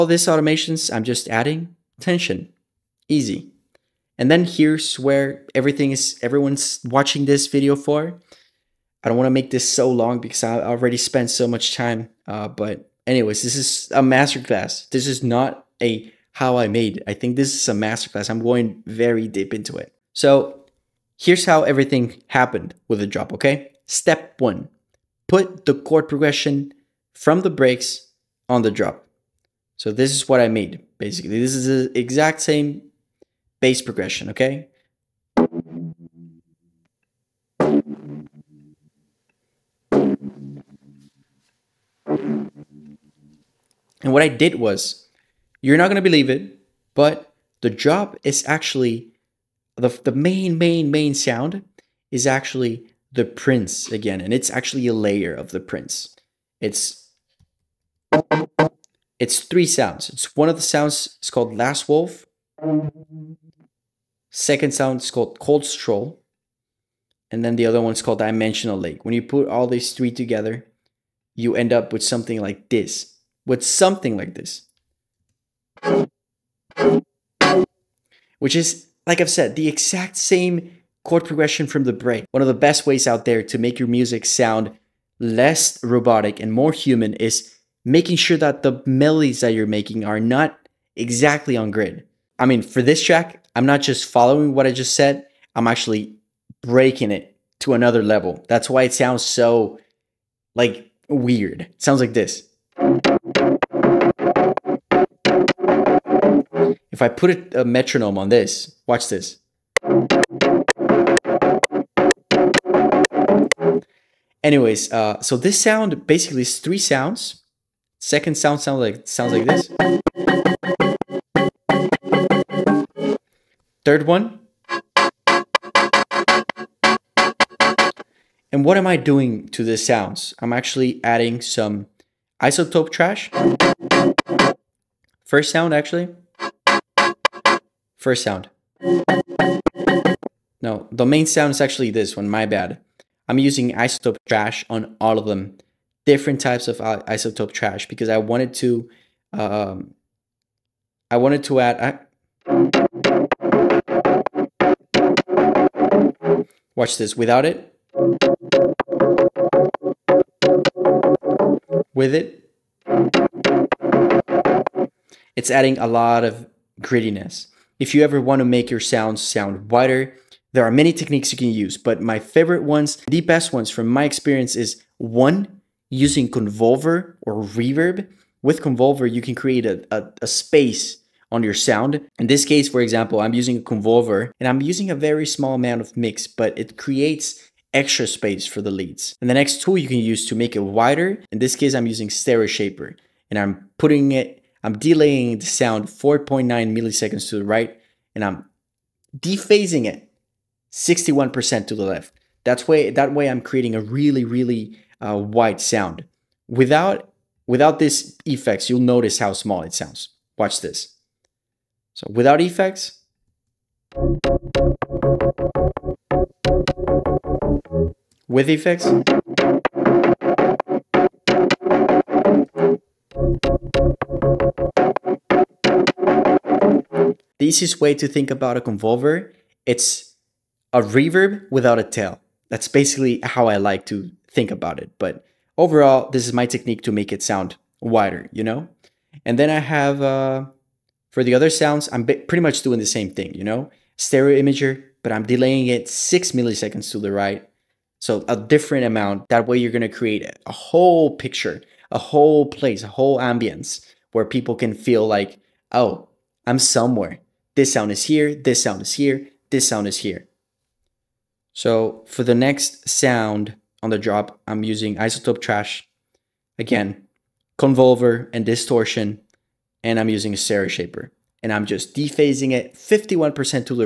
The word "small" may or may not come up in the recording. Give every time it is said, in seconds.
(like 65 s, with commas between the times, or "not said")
185 s, 209 s.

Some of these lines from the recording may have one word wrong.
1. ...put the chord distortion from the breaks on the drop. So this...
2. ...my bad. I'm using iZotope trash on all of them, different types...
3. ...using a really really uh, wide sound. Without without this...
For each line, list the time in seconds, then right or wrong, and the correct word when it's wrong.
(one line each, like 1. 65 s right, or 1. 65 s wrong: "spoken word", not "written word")
1. 25 s wrong: "progression", not "distortion"
2. 142 s right
3. 203 s wrong: "creating", not "using".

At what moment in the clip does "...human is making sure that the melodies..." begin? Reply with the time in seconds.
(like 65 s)
86 s.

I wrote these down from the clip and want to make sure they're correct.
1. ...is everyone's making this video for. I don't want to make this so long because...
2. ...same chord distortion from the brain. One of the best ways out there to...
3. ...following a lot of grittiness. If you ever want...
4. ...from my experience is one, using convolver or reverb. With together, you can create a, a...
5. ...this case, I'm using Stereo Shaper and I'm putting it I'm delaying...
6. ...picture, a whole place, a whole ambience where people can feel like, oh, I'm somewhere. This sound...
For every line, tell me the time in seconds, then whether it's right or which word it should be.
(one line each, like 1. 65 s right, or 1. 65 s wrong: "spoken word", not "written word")
1. 5 s wrong: "watching", not "making"
2. 80 s wrong: "progression", not "distortion"
3. 165 s wrong: "adding", not "following"
4. 173 s wrong: "convolver", not "together"
5. 191 s right
6. 251 s right.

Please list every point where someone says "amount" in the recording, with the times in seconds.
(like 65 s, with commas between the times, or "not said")
185 s, 248 s.